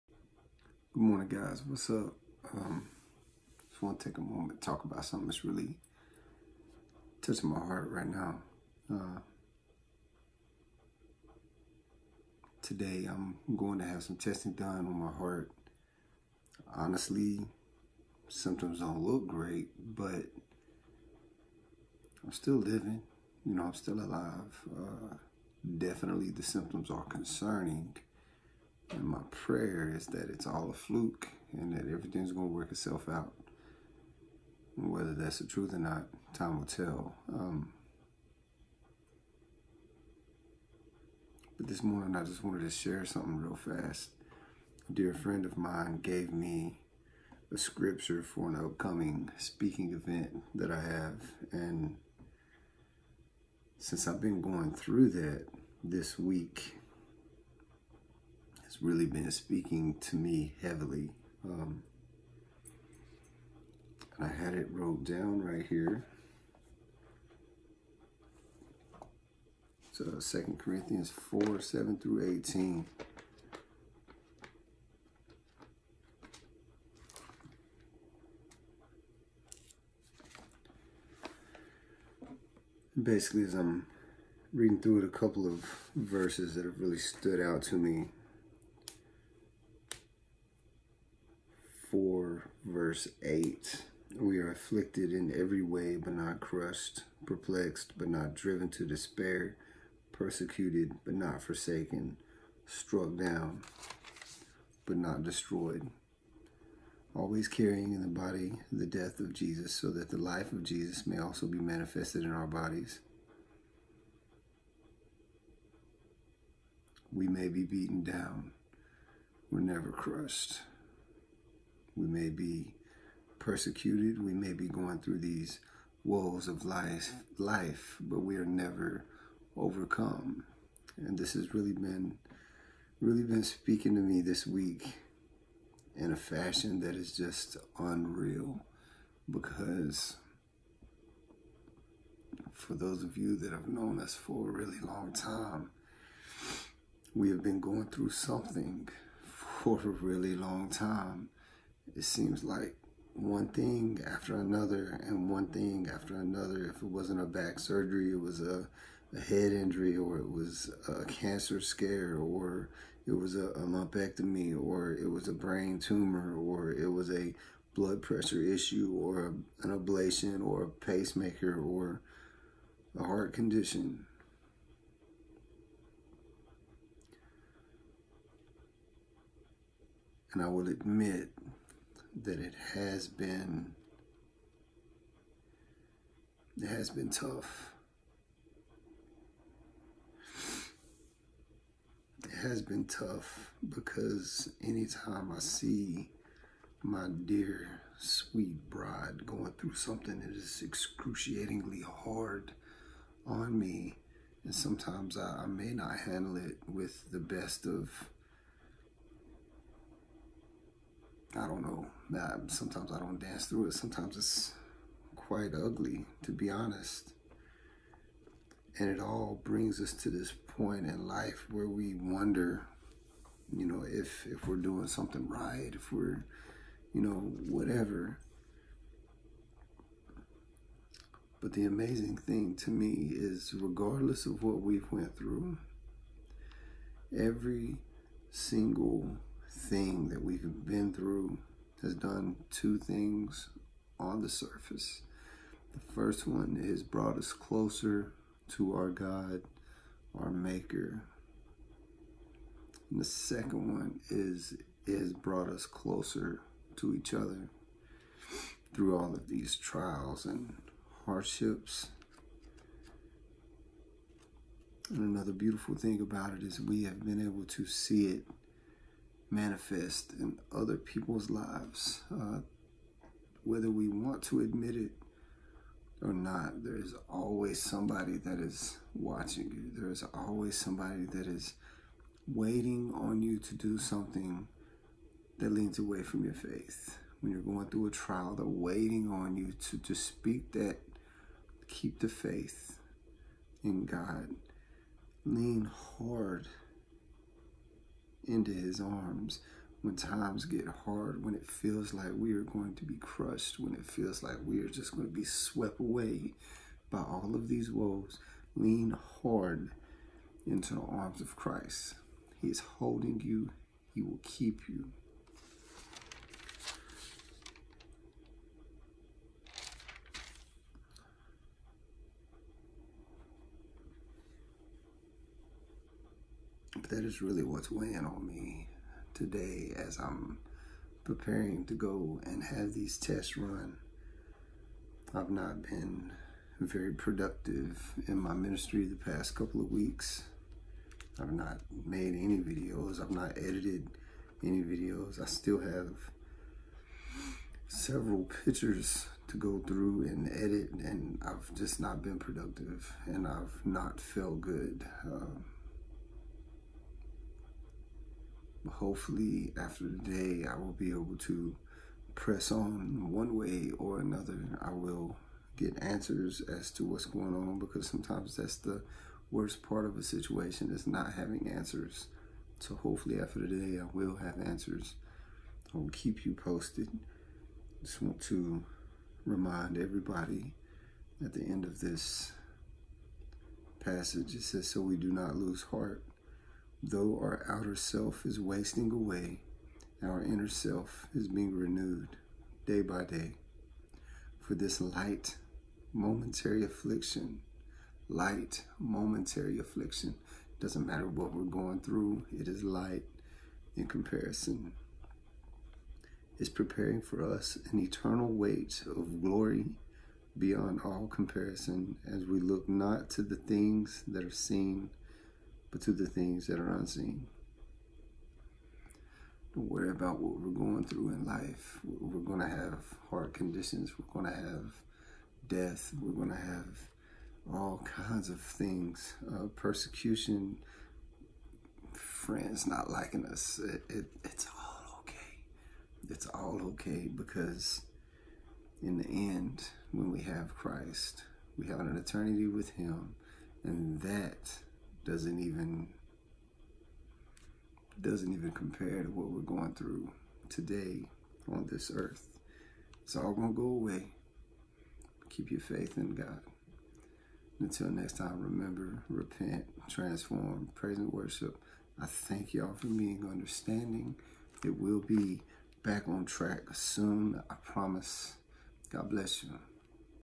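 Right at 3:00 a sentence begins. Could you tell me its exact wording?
And I will admit that it has been it has been tough.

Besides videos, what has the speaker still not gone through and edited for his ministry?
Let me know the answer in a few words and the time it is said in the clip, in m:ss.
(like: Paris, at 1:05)
Pictures, at 5:48.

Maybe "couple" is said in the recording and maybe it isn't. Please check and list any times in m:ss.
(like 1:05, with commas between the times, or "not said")
1:25, 5:39.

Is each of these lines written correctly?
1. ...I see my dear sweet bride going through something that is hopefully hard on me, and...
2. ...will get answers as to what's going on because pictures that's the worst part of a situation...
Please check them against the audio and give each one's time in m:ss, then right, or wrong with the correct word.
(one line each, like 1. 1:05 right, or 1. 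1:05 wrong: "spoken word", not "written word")
1. 3:15 wrong: "excruciatingly", not "hopefully"
2. 6:04 wrong: "sometimes", not "pictures".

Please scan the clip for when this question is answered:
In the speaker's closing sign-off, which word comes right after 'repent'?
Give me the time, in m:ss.
7:39.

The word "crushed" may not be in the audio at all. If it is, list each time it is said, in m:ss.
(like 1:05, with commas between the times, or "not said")
1:36, 1:59, 5:02.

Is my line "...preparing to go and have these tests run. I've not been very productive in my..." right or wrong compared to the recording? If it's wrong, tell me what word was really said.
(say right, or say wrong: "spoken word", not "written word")
right.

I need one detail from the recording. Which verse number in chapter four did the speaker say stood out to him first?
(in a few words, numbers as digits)
Verse 8.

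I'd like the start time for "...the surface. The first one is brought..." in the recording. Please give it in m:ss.
4:04.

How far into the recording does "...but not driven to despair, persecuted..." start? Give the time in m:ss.
1:37.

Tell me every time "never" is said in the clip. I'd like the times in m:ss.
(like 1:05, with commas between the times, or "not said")
1:59, 2:08.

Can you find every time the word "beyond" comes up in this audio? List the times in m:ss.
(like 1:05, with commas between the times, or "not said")
6:50.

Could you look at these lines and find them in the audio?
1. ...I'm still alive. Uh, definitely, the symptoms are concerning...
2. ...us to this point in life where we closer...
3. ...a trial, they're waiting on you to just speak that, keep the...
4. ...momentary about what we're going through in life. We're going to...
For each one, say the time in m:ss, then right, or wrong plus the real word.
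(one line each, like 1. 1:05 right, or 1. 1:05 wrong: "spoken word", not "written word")
1. 0:23 right
2. 3:39 wrong: "wonder", not "closer"
3. 4:47 right
4. 6:59 wrong: "worry", not "momentary".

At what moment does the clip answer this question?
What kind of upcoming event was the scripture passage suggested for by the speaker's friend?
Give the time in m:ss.
0:49.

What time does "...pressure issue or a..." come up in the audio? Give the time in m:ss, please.
2:48.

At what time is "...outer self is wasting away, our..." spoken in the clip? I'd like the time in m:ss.
6:27.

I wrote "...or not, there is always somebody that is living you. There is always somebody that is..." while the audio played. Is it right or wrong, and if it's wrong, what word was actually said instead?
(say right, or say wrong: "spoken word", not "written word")
wrong: "watching", not "living".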